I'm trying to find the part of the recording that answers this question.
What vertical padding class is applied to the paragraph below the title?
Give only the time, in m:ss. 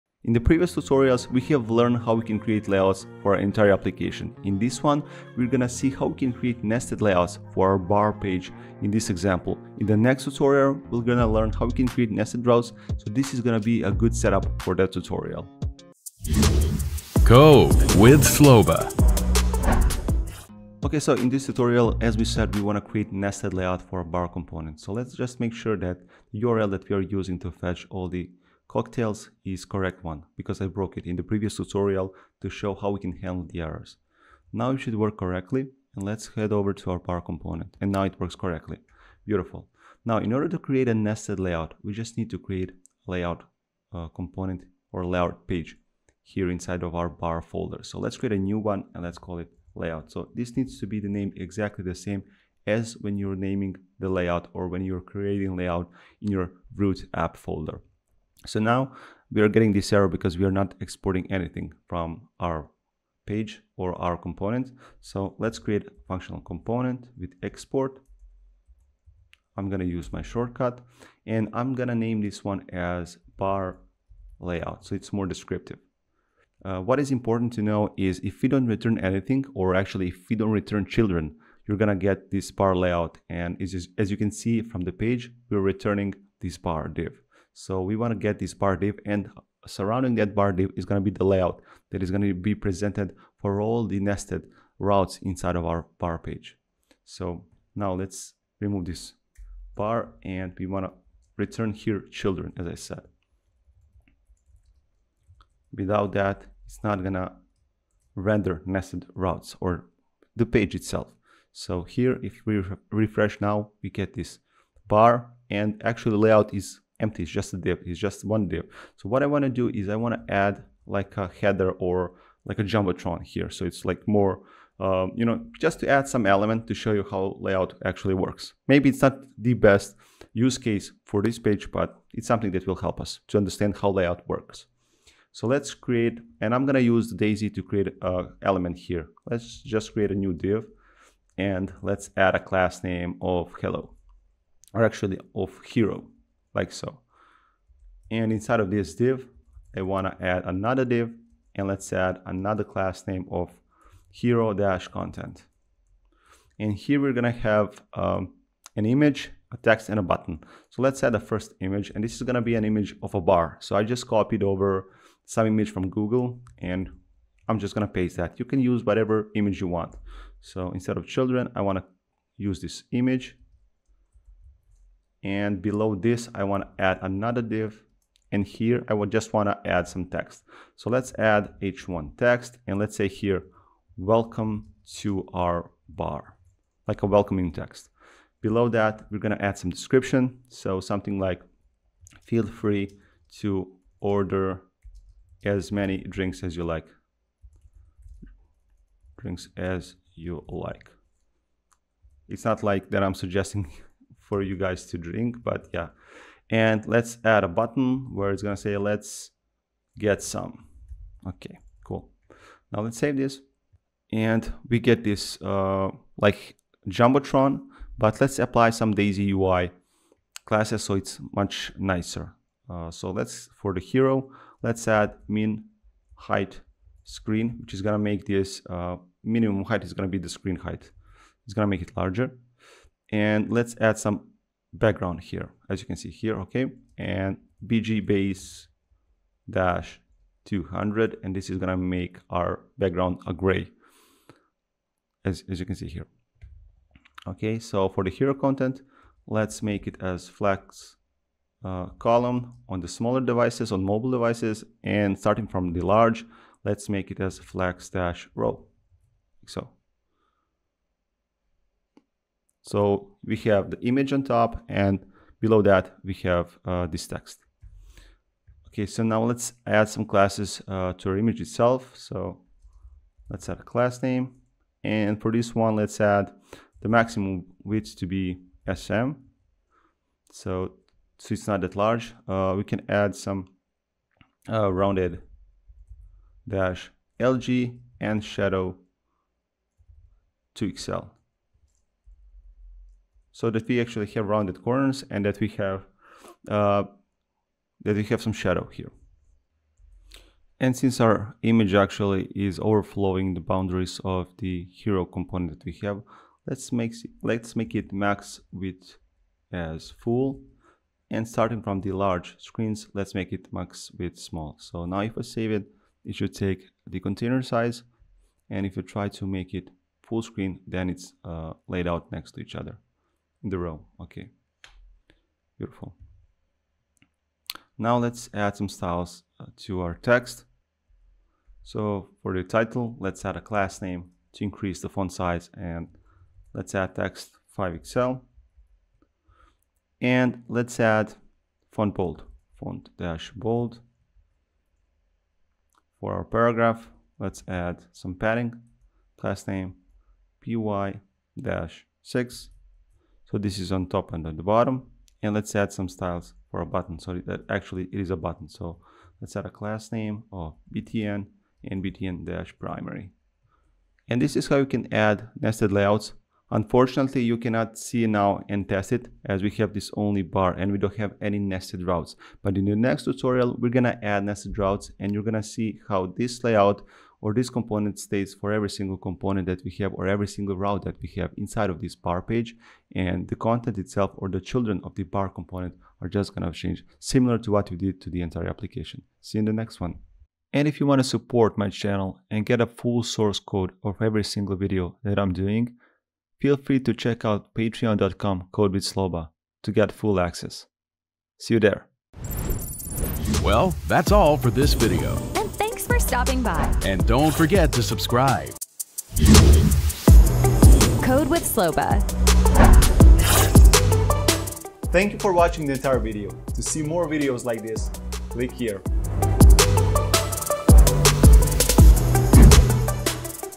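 5:50.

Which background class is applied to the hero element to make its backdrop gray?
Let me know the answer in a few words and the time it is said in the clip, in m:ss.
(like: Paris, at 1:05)
bg base-200, at 3:57.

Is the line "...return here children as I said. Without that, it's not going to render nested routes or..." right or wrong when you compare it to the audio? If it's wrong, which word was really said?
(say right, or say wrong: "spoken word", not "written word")
right.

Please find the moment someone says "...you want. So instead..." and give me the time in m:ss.
2:49.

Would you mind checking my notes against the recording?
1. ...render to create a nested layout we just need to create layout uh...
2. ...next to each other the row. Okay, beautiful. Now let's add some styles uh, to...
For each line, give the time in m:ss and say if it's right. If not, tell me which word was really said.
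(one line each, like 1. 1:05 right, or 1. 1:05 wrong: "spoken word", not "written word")
1. 0:40 wrong: "order", not "render"
2. 5:22 right.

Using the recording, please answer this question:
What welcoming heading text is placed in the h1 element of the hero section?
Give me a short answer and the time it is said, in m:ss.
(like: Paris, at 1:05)
welcome to our bar, at 3:03.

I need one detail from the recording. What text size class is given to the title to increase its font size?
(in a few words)
text 5XL.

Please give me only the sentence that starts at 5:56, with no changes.
So that actually it is a button.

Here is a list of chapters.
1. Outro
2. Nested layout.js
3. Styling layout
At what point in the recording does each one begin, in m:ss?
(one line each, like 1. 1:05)
1. 6:03
2. 0:40
3. 3:35.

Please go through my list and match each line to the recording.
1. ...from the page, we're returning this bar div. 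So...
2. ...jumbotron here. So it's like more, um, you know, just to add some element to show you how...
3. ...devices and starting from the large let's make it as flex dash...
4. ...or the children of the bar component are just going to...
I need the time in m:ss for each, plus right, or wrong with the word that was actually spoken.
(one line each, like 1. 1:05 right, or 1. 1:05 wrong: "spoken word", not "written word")
1. 1:24 right
2. 2:02 right
3. 4:14 right
4. 6:24 right.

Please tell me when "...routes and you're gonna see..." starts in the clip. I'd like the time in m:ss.
6:14.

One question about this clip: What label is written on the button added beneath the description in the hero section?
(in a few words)
let's get some.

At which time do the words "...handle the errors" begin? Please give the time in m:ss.
0:33.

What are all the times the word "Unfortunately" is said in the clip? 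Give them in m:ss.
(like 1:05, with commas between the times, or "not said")
6:06.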